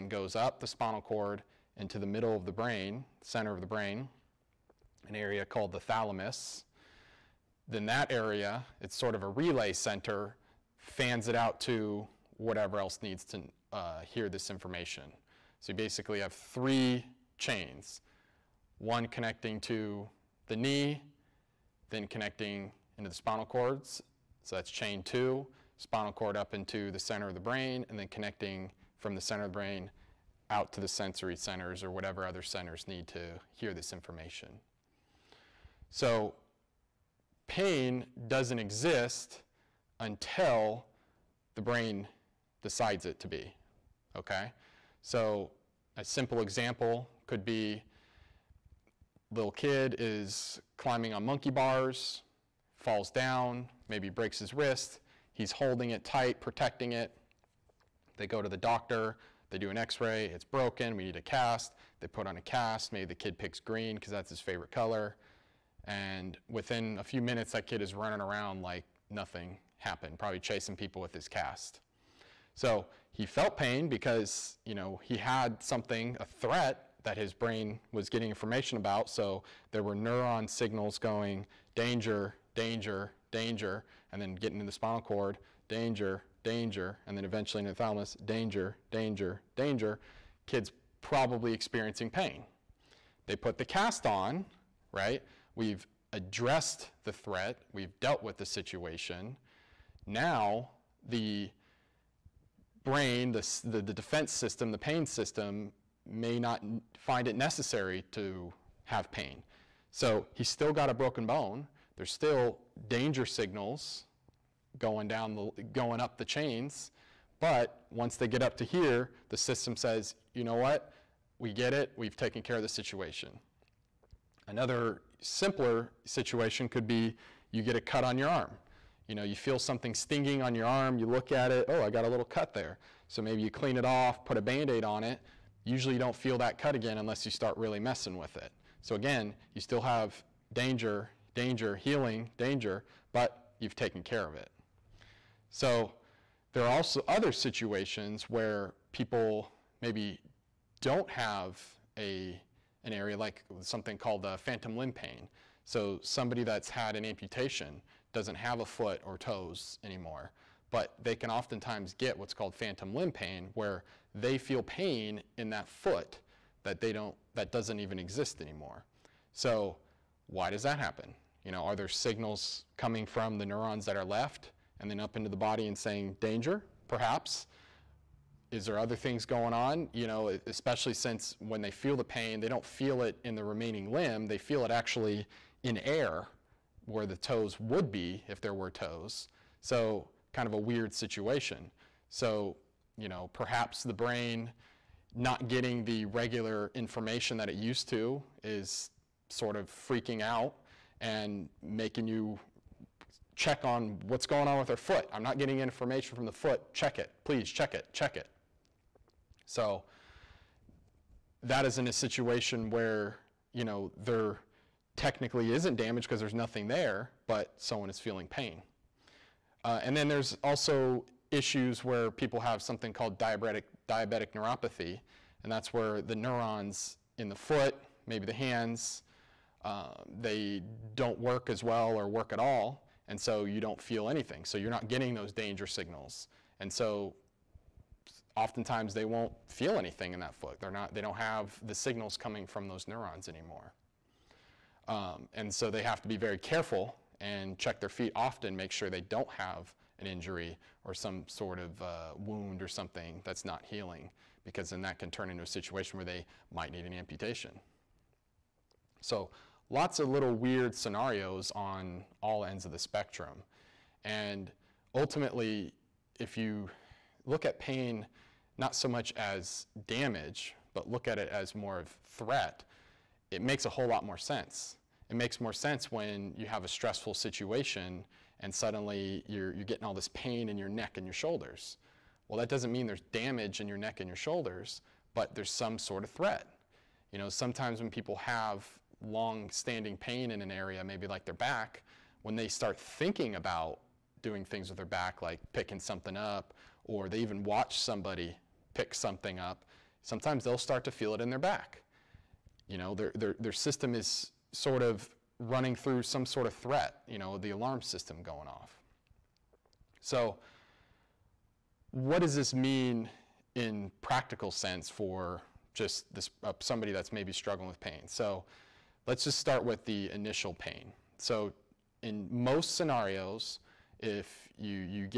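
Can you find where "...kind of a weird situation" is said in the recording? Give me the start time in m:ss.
3:10.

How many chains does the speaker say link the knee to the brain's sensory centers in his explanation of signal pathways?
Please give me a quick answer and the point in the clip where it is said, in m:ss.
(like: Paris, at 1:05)
3, at 0:16.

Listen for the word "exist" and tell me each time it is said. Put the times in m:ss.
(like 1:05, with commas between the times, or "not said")
0:38, 2:47.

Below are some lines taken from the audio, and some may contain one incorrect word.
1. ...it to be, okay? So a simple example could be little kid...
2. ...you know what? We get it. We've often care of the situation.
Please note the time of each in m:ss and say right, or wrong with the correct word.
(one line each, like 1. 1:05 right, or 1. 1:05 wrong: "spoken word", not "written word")
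1. 0:43 right
2. 2:00 wrong: "taken", not "often".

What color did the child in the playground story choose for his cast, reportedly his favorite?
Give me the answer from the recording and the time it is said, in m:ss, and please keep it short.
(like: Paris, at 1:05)
green, at 1:03.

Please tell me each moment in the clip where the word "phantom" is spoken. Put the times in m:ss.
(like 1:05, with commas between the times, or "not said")
2:34, 2:42.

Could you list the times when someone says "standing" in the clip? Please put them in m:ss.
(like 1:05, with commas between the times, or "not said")
4:49.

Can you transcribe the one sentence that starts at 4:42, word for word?
Well, that doesn't mean there's damage in your neck and your shoulders, but there's some sort of threat.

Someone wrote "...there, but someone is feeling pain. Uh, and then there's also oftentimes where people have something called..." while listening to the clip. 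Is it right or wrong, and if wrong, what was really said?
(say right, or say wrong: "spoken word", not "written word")
wrong: "issues", not "oftentimes".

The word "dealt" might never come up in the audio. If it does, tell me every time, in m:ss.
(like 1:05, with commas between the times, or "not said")
1:37.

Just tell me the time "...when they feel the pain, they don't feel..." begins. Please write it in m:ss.
3:01.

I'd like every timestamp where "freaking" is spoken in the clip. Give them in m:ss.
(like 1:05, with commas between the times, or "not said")
3:19.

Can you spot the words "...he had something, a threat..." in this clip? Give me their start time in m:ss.
1:15.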